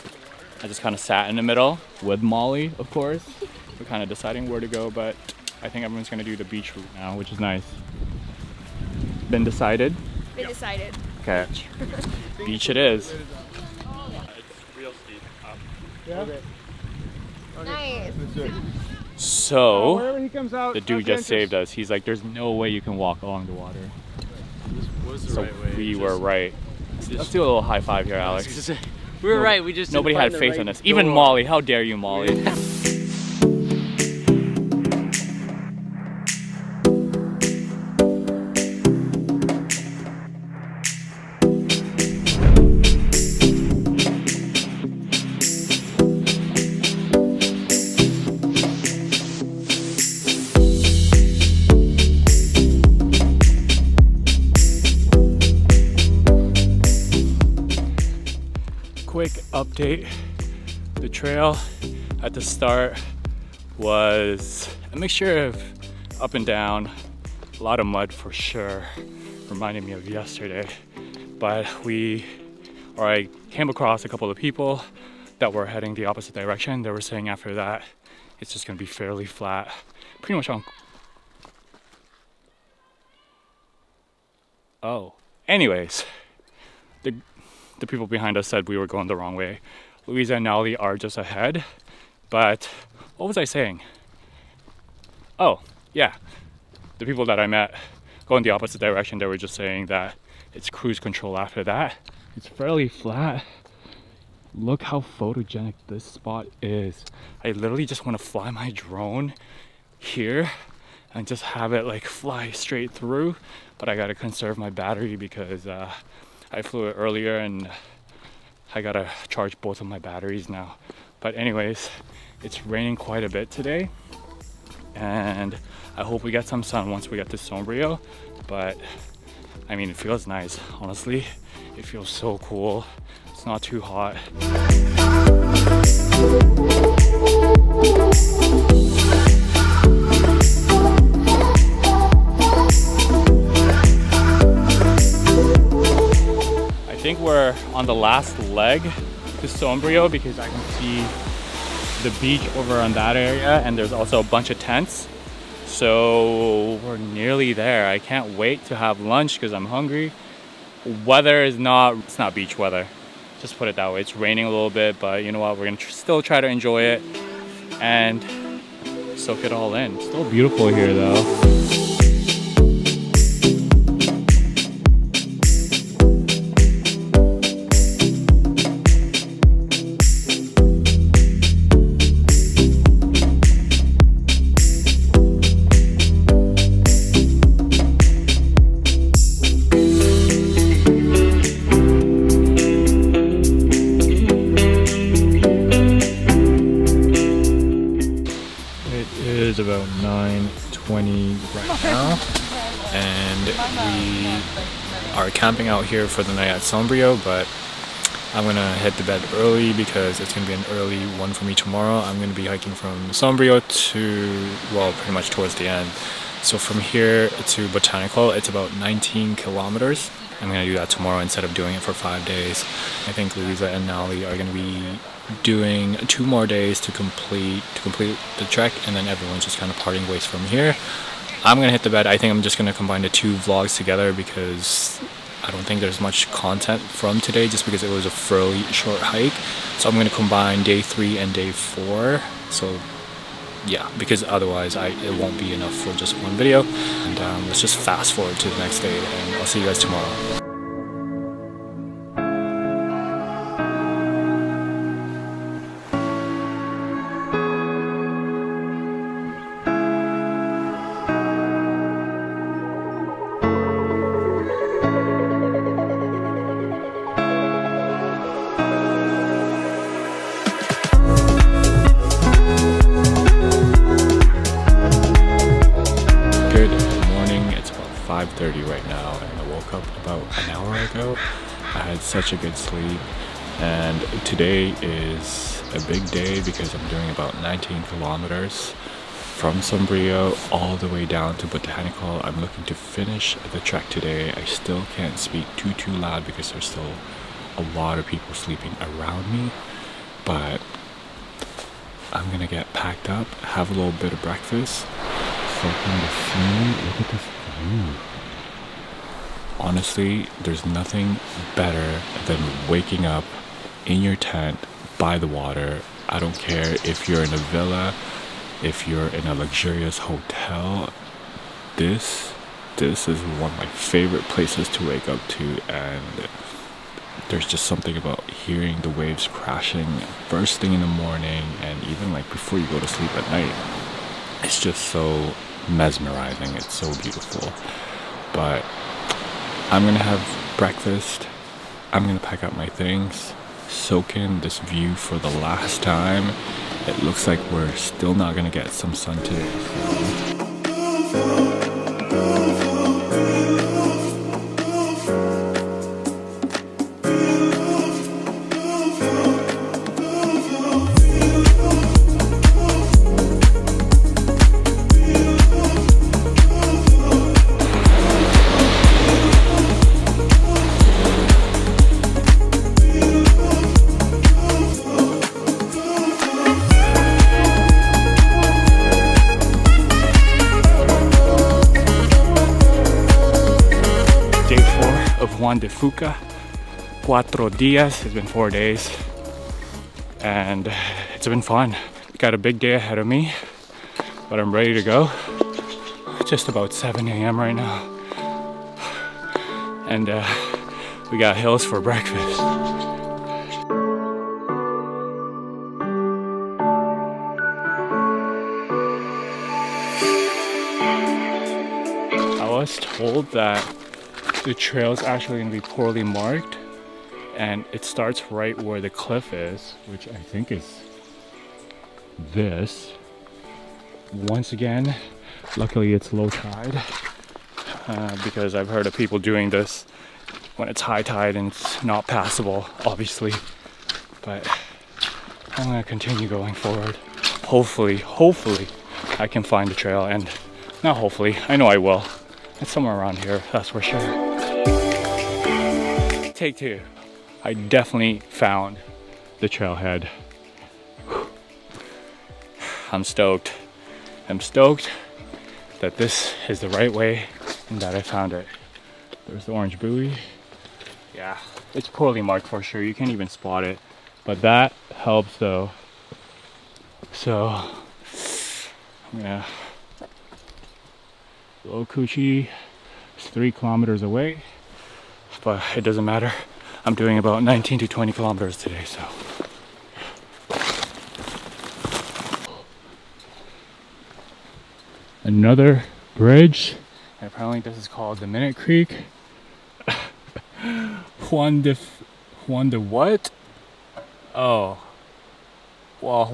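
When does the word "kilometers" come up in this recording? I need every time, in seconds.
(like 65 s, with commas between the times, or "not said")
219 s, 287 s, 473 s, 478 s.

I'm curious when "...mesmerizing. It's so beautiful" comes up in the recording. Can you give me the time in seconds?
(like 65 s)
335 s.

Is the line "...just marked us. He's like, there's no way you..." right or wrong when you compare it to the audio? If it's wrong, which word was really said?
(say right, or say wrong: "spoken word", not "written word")
wrong: "saved", not "marked".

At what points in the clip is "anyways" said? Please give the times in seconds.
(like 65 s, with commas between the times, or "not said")
85 s, 121 s.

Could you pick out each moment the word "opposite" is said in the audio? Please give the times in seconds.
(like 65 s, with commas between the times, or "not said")
76 s, 98 s.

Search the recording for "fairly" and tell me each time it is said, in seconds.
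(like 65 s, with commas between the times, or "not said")
78 s, 102 s, 238 s.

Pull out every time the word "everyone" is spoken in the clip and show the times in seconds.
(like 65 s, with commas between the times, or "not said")
5 s, 229 s.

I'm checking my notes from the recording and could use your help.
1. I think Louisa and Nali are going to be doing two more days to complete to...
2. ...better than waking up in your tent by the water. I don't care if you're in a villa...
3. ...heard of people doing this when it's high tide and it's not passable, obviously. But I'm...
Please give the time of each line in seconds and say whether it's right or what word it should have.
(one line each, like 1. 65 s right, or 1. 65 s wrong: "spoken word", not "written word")
1. 223 s right
2. 311 s right
3. 428 s right.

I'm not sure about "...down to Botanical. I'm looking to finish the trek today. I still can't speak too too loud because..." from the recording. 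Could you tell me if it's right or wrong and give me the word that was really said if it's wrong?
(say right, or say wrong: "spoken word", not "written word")
right.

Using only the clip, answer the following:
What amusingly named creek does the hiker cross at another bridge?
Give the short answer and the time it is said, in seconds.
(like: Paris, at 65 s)
Minute Creek, at 488 s.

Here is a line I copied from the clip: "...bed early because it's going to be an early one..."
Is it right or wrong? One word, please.
right.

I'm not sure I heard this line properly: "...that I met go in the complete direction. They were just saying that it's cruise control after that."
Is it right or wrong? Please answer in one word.
wrong.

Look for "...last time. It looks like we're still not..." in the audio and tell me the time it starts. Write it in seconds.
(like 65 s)
345 s.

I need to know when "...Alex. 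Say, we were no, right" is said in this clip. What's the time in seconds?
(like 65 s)
28 s.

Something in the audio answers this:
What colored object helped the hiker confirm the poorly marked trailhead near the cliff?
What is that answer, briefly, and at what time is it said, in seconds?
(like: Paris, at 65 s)
orange buoy, at 459 s.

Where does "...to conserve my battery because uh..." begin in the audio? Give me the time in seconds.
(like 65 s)
114 s.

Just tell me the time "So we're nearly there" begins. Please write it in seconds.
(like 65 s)
155 s.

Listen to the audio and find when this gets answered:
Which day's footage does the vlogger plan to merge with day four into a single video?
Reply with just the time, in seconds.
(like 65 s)
240 s.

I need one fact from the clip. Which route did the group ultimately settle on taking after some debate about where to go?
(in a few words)
beach route.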